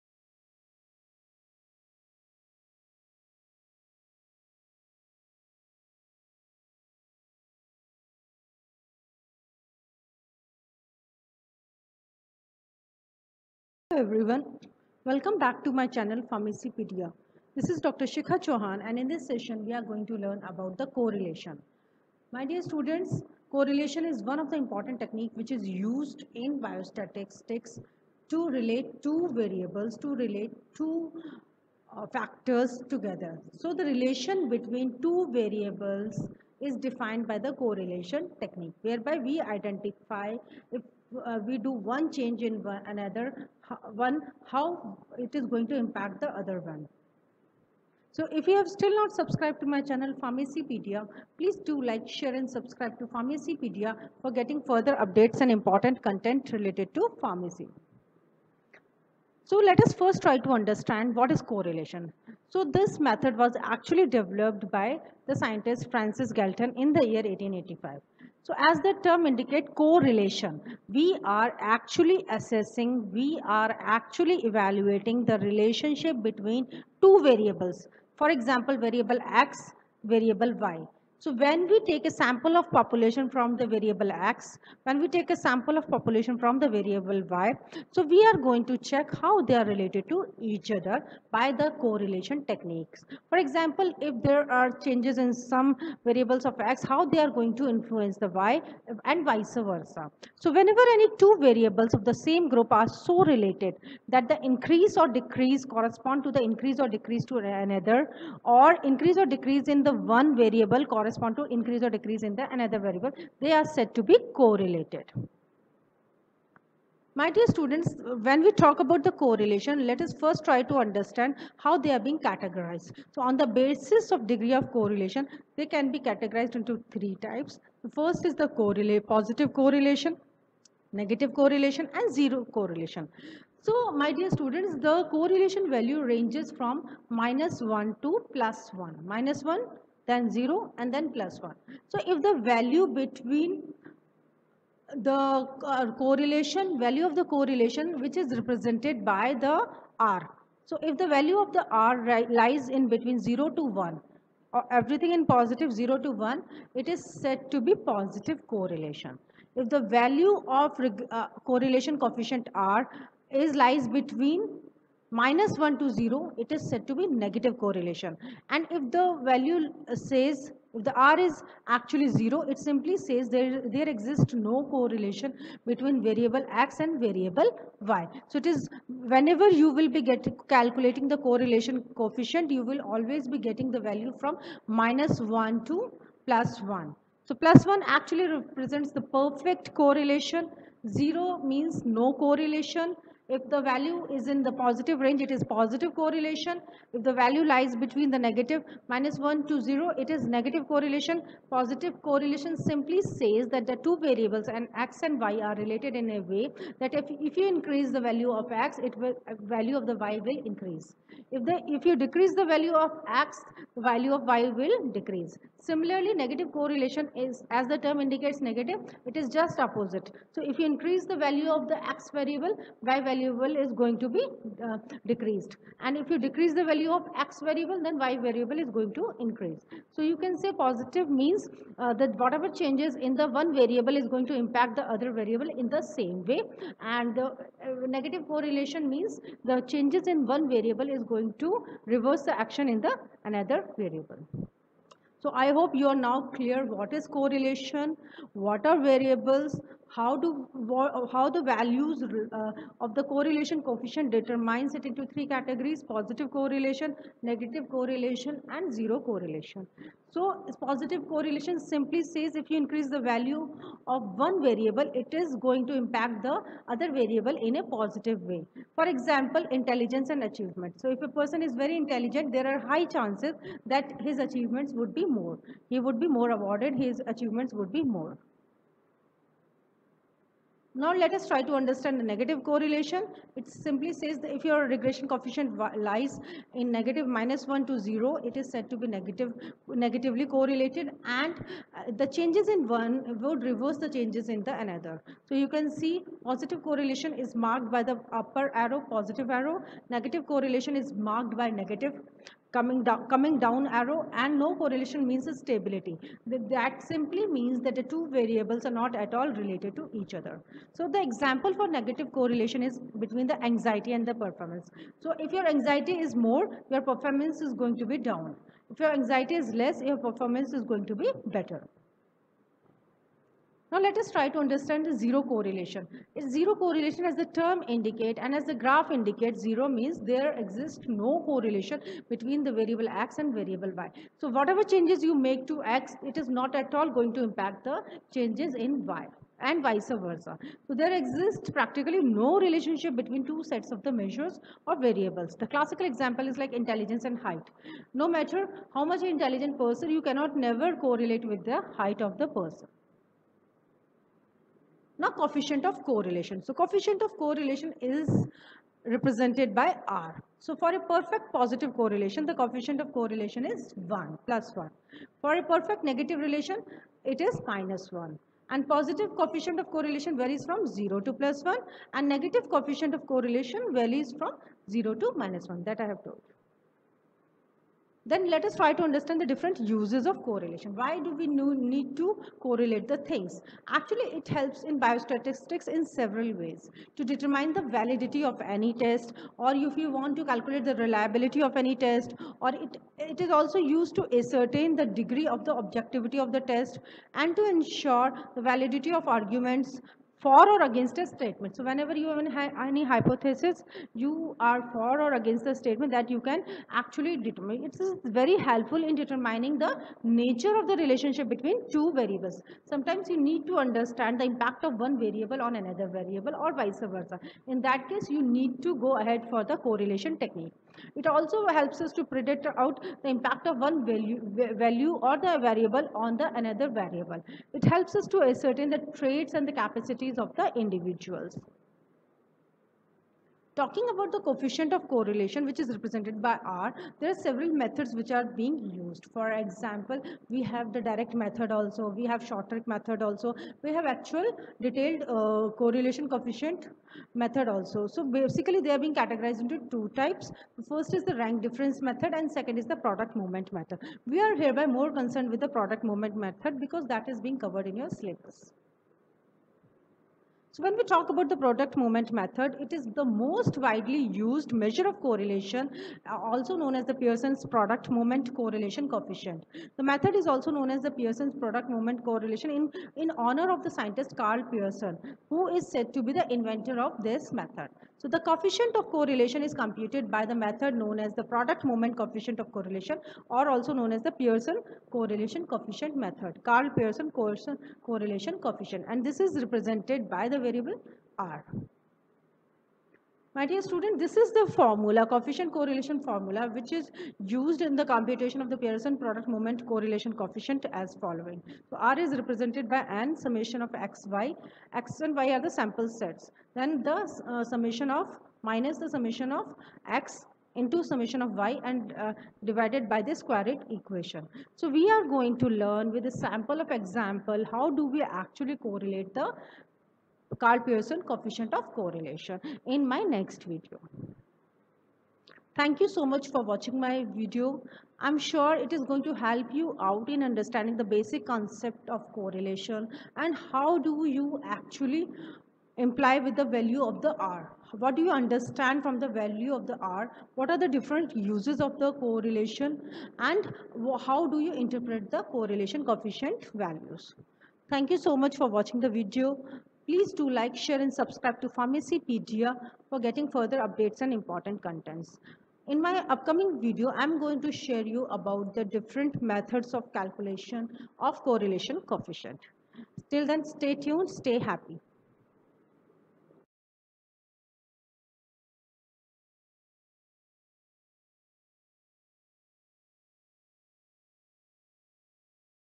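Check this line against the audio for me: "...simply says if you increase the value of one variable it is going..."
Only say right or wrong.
right.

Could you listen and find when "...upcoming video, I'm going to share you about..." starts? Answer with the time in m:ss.
9:16.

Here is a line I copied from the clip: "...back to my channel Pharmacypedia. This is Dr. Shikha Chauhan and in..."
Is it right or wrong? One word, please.
right.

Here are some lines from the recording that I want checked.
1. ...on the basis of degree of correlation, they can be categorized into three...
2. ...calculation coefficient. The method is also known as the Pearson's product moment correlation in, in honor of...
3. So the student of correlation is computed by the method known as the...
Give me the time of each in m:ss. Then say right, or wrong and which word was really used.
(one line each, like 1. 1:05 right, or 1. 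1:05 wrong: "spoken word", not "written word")
1. 2:03 right
2. 7:48 wrong: "correlation", not "calculation"
3. 7:58 wrong: "coefficient", not "student".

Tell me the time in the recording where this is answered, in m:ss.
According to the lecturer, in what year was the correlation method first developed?
1:07.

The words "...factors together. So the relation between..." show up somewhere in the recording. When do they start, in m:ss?
0:32.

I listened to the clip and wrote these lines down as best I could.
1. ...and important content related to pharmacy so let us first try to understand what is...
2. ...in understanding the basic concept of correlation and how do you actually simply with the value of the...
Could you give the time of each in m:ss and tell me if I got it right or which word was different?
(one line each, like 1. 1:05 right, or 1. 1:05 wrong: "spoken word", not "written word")
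1. 0:55 right
2. 8:50 wrong: "imply", not "simply".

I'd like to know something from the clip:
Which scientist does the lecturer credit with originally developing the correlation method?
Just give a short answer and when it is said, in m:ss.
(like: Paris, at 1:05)
Francis Galton, at 1:05.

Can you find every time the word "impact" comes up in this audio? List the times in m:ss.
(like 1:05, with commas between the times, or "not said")
0:45, 3:54, 4:25, 5:37, 6:54, 7:03.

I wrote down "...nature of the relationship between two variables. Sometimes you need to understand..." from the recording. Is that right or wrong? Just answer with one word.
right.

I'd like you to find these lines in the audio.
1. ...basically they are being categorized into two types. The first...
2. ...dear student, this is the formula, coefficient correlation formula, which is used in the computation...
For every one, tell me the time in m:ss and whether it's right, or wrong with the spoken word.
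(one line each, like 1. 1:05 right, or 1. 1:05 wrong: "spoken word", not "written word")
1. 7:28 right
2. 8:13 right.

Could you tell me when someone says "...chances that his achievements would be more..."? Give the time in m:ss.
4:32.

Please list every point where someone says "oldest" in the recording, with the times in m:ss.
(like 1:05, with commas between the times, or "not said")
not said.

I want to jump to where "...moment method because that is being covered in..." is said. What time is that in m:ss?
7:35.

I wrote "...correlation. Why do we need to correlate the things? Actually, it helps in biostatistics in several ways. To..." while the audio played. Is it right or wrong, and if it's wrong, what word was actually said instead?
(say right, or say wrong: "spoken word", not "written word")
right.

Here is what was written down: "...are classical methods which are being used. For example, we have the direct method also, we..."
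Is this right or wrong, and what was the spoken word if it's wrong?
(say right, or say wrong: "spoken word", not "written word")
wrong: "several", not "classical".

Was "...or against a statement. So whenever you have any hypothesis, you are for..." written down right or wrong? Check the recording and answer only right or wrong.
right.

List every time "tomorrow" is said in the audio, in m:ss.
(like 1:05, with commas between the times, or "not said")
not said.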